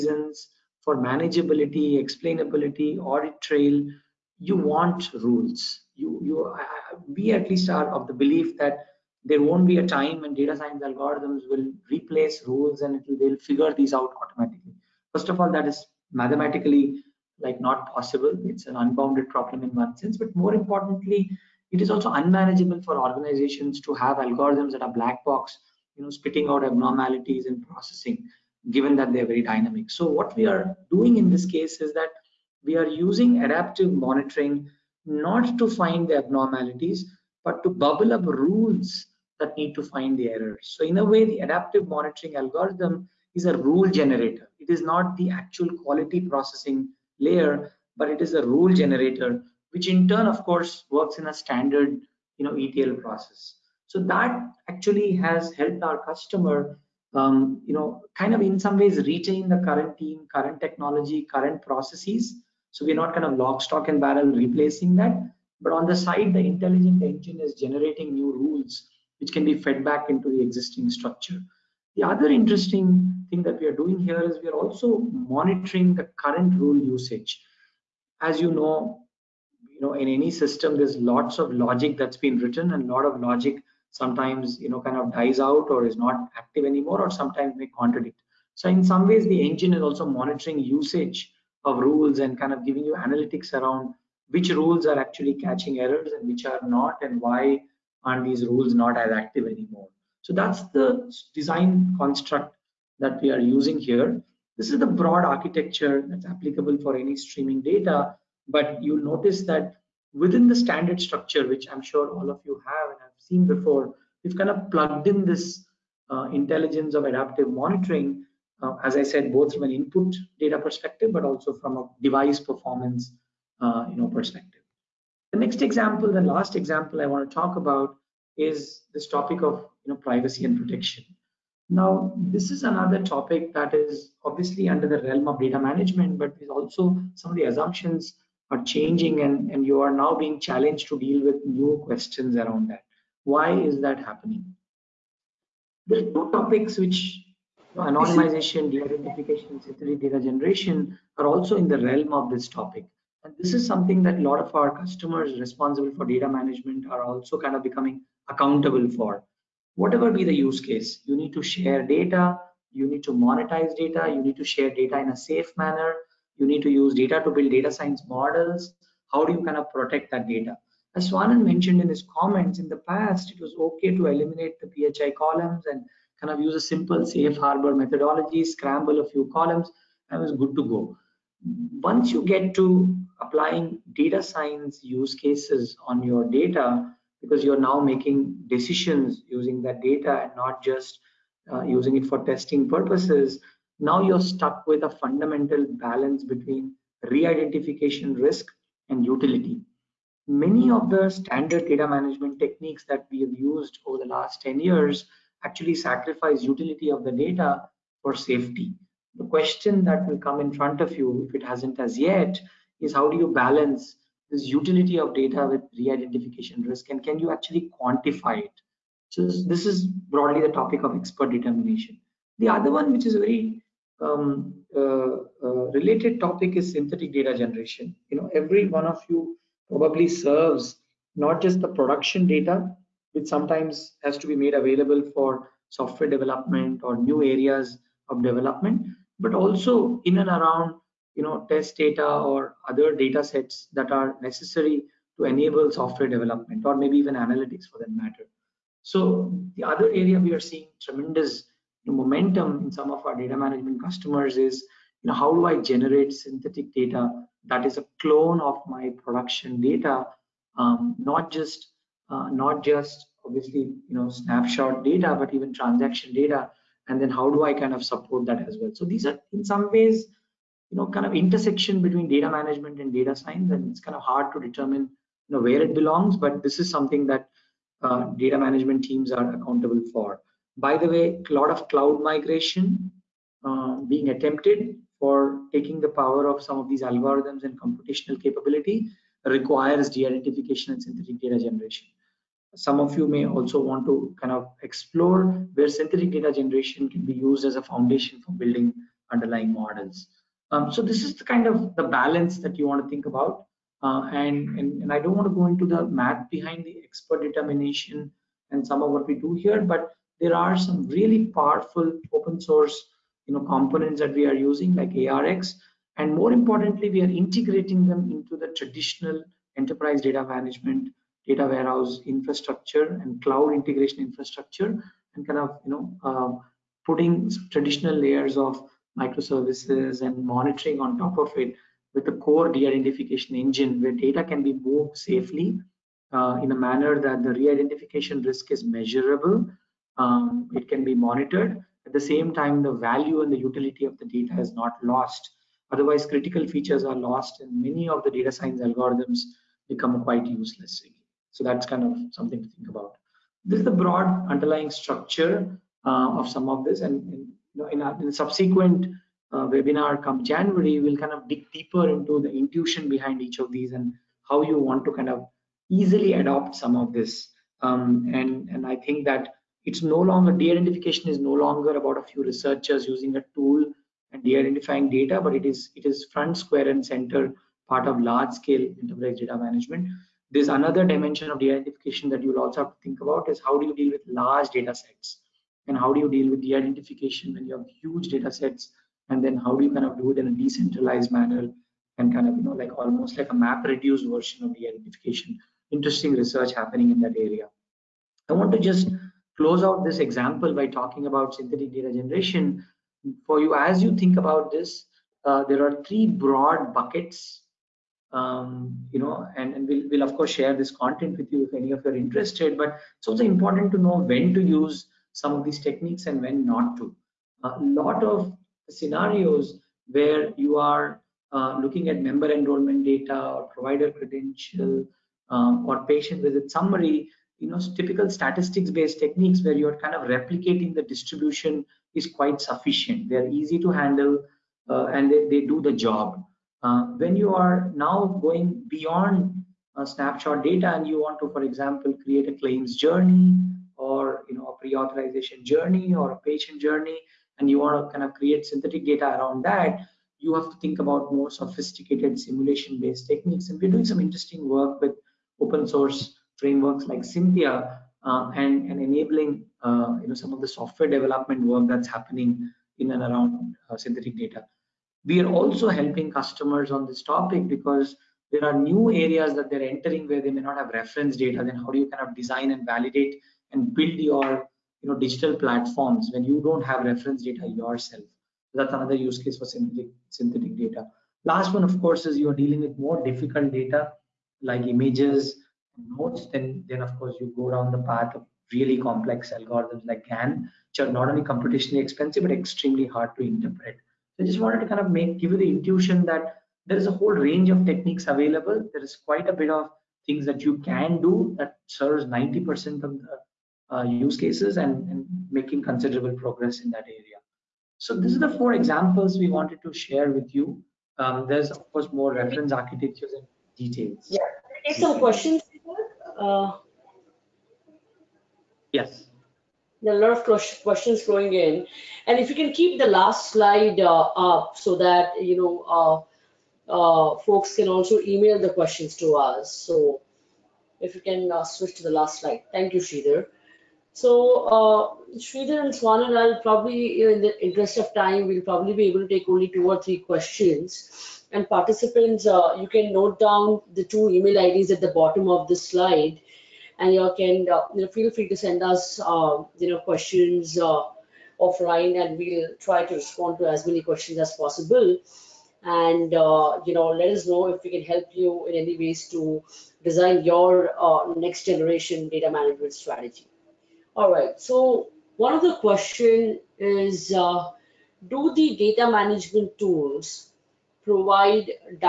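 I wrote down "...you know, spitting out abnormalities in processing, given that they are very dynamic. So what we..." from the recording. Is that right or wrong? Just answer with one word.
right.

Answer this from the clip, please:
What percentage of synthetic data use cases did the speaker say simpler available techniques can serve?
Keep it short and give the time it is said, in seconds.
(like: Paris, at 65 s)
90%, at 502 s.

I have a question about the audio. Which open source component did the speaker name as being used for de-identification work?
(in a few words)
ARX.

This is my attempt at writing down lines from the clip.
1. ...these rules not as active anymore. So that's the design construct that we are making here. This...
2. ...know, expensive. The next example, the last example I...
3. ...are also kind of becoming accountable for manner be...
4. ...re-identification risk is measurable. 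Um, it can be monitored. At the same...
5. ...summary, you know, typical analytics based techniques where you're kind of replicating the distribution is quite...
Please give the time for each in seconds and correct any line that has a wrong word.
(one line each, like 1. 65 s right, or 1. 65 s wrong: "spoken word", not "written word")
1. 98 s wrong: "using", not "making"
2. 123 s wrong: "perspective", not "expensive"
3. 156 s wrong: "whatever", not "manner"
4. 337 s right
5. 426 s wrong: "statistics", not "analytics".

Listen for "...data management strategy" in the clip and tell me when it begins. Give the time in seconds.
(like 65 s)
562 s.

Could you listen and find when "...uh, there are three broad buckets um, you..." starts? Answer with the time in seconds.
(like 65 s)
405 s.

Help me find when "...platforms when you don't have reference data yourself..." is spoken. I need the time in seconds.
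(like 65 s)
475 s.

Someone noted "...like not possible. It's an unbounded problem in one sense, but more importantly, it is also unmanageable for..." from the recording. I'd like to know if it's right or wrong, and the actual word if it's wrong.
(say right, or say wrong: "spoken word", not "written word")
right.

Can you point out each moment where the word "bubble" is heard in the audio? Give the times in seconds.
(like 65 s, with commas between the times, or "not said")
37 s.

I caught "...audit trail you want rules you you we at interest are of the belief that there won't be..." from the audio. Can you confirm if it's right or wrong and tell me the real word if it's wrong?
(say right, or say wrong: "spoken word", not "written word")
wrong: "least", not "interest".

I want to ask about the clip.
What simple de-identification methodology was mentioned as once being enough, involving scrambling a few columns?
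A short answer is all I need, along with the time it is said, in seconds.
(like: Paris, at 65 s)
Safe harbor, at 177 s.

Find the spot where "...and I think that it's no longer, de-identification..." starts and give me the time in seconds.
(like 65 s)
368 s.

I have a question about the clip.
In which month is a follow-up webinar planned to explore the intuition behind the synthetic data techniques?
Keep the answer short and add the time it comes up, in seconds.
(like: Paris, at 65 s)
January, at 360 s.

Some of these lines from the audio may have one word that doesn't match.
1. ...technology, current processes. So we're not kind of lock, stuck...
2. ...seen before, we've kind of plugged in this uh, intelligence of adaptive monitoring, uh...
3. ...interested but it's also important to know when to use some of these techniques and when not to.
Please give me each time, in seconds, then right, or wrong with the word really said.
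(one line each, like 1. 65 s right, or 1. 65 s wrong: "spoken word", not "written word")
1. 60 s wrong: "stock", not "stuck"
2. 113 s right
3. 411 s right.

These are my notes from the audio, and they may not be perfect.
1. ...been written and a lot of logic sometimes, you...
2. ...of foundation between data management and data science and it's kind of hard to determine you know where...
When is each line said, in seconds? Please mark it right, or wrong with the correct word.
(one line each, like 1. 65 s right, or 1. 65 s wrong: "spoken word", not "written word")
1. 82 s right
2. 271 s wrong: "intersection", not "foundation".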